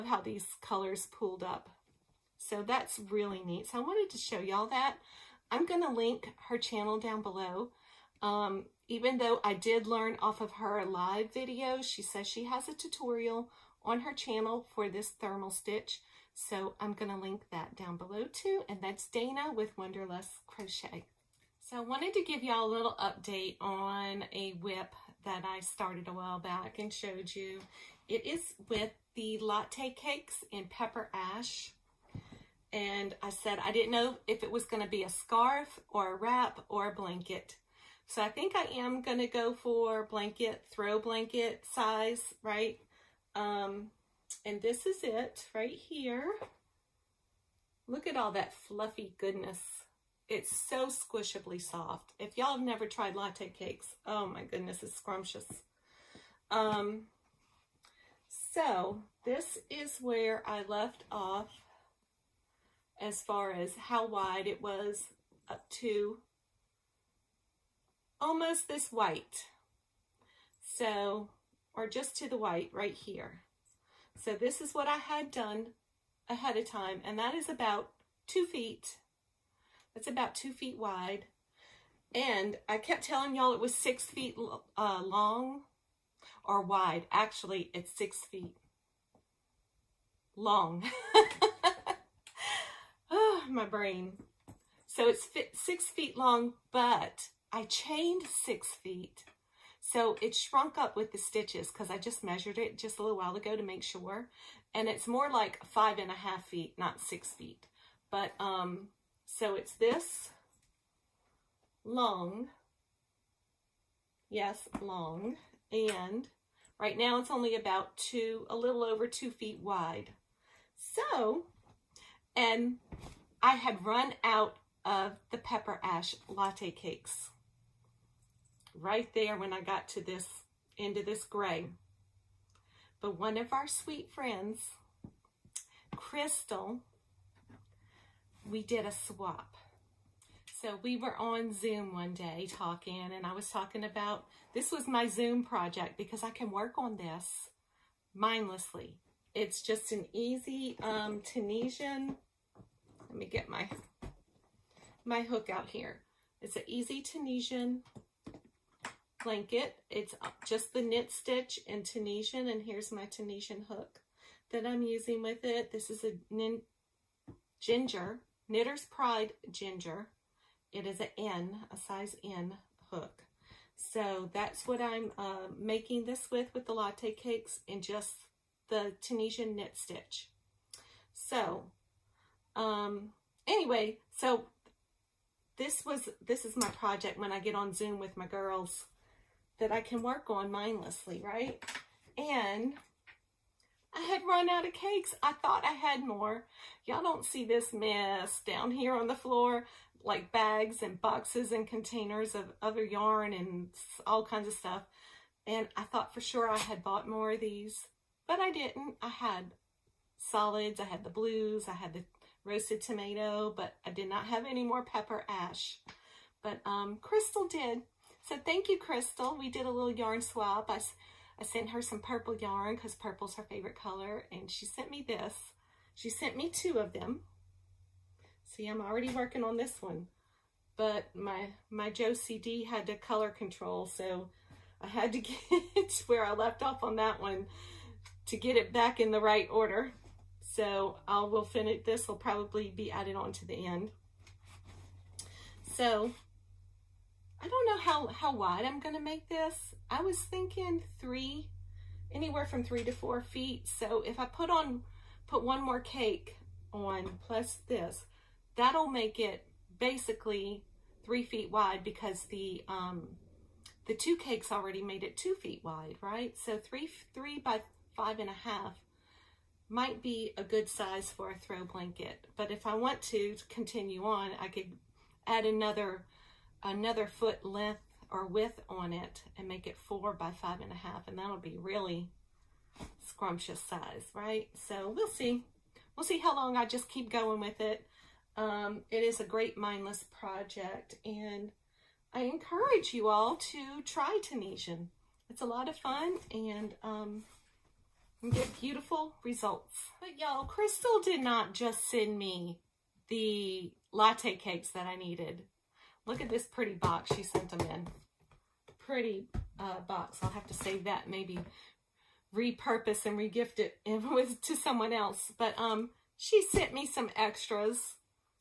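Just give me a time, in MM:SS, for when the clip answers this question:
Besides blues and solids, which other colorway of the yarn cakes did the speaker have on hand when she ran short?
03:32.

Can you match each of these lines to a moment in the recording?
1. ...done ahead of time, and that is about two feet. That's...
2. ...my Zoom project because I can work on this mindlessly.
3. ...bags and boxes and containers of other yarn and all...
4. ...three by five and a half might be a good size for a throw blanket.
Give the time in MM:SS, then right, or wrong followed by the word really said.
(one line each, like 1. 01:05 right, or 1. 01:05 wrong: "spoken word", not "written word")
1. 01:15 right
2. 02:24 right
3. 03:20 right
4. 04:27 right.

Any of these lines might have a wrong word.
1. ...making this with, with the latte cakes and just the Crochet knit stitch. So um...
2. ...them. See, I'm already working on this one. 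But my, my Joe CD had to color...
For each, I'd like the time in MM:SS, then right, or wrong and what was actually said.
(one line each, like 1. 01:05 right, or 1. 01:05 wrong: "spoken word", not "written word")
1. 02:55 wrong: "Tunisian", not "Crochet"
2. 03:46 right.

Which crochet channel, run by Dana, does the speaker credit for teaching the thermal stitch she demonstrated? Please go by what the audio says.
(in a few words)
Wanderlust Crochet.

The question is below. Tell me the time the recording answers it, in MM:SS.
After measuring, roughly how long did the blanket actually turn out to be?
01:45.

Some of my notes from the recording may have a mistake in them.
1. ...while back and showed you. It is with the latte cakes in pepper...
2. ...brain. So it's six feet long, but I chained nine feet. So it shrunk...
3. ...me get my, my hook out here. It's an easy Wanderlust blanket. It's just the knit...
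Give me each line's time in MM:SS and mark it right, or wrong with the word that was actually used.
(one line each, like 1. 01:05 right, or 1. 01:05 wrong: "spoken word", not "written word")
1. 00:26 right
2. 01:33 wrong: "six", not "nine"
3. 02:33 wrong: "Tunisian", not "Wanderlust".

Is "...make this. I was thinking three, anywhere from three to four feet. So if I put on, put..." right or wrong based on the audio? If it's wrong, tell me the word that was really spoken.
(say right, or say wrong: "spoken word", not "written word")
right.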